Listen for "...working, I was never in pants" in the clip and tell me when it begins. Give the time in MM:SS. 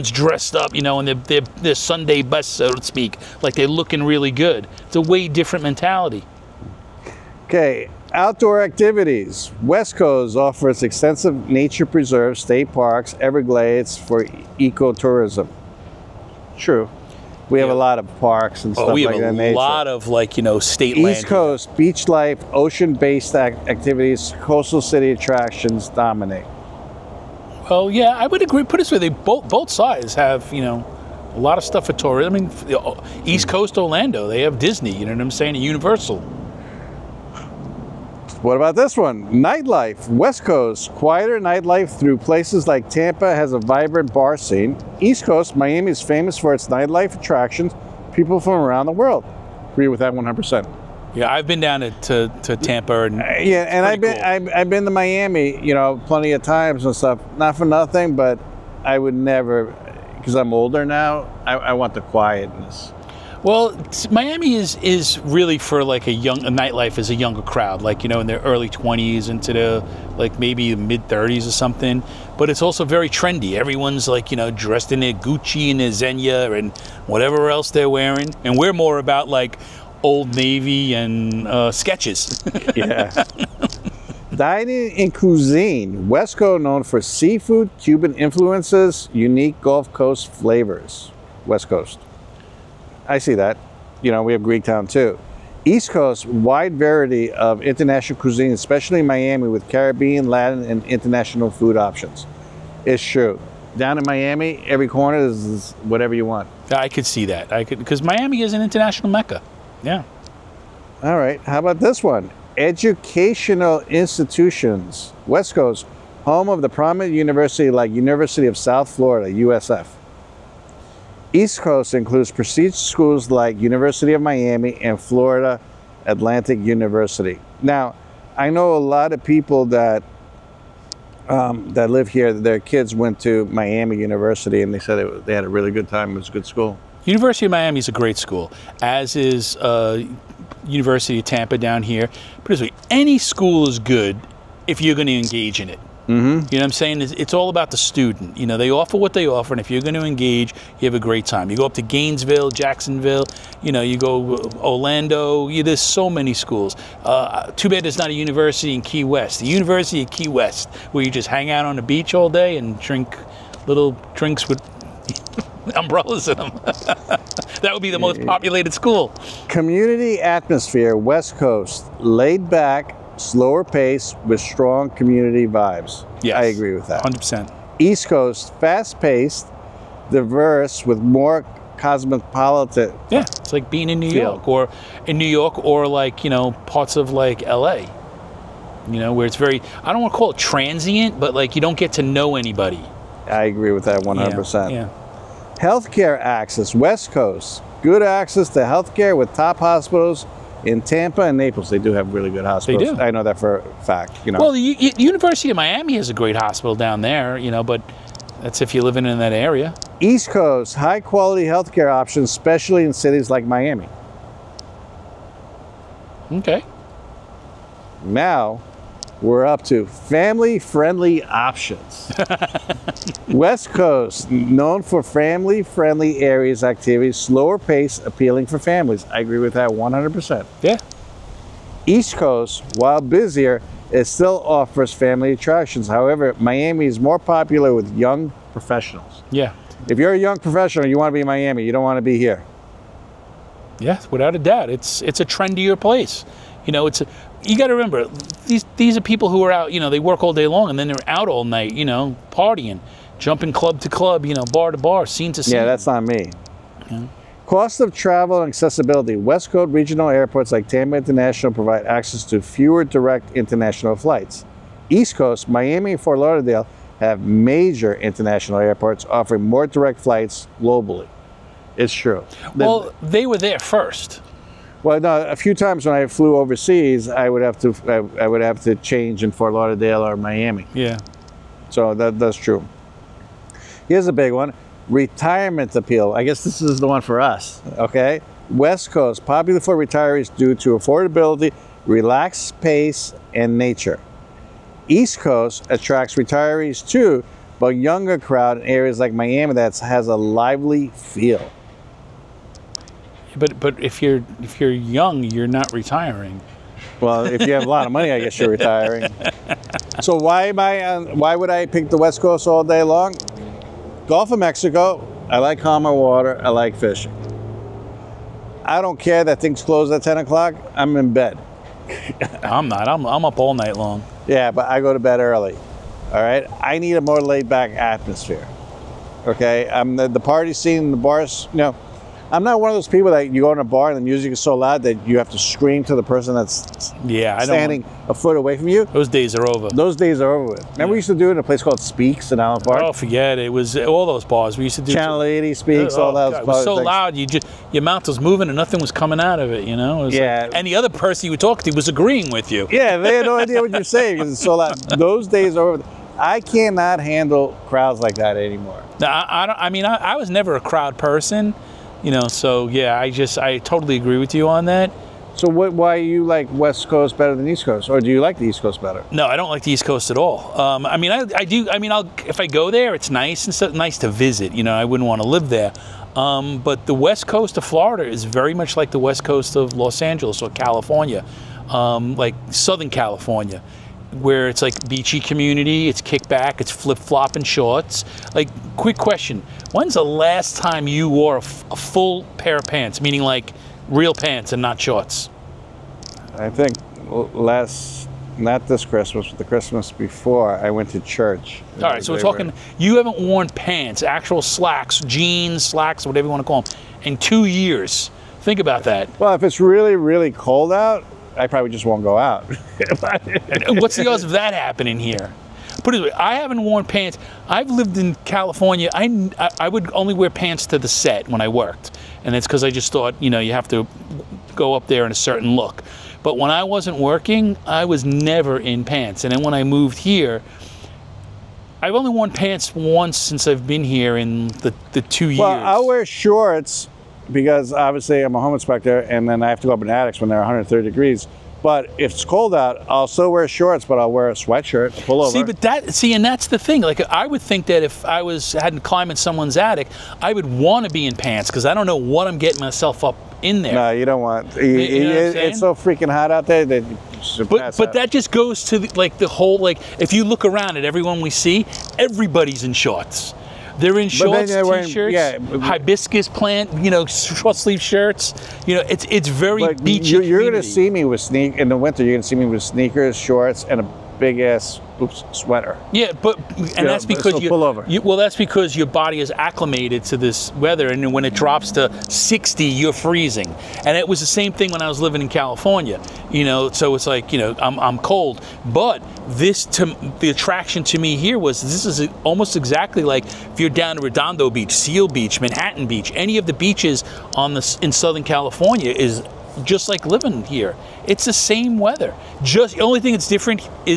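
07:06.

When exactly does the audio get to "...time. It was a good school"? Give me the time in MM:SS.
02:15.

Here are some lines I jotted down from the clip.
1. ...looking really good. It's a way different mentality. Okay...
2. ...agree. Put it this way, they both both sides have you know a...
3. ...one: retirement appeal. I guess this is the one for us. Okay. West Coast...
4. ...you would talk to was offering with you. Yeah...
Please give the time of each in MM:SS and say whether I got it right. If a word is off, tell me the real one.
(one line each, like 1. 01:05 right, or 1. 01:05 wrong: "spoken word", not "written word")
1. 00:03 right
2. 00:28 right
3. 04:44 right
4. 05:51 wrong: "agreeing", not "offering".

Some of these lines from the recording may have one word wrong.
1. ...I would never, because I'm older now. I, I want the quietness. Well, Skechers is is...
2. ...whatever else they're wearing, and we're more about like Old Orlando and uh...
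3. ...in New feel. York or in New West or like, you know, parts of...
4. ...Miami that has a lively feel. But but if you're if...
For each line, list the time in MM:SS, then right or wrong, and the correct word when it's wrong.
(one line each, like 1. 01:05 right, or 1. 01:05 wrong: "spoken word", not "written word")
1. 00:58 wrong: "Miami", not "Skechers"
2. 01:17 wrong: "Navy", not "Orlando"
3. 03:03 wrong: "York", not "West"
4. 04:59 right.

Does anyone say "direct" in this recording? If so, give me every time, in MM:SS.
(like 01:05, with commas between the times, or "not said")
04:22, 04:29.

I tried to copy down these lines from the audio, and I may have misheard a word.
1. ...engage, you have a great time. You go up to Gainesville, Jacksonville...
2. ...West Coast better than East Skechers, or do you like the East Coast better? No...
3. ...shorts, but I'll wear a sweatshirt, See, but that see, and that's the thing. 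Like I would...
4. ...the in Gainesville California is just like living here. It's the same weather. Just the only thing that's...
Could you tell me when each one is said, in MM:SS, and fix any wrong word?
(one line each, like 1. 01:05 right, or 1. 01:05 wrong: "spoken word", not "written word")
1. 02:30 right
2. 06:06 wrong: "Coast", not "Skechers"
3. 07:23 right
4. 08:17 wrong: "Southern", not "Gainesville".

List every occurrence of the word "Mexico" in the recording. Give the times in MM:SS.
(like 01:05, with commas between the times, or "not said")
05:14.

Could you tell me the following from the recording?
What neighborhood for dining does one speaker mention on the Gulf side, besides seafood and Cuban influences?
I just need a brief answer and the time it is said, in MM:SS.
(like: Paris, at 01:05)
Greek town, at 01:34.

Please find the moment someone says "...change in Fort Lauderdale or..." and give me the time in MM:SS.
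04:38.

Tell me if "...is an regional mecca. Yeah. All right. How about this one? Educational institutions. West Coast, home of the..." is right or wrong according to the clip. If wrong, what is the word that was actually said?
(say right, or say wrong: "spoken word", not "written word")
wrong: "international", not "regional".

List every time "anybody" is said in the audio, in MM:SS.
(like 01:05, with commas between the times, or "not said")
03:12.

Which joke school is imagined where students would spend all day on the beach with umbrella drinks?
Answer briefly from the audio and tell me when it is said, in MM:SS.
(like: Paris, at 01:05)
University of Key West, at 02:39.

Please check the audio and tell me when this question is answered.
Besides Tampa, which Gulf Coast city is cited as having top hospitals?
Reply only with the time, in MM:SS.
03:21.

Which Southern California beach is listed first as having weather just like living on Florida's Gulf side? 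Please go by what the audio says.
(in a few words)
Redondo Beach.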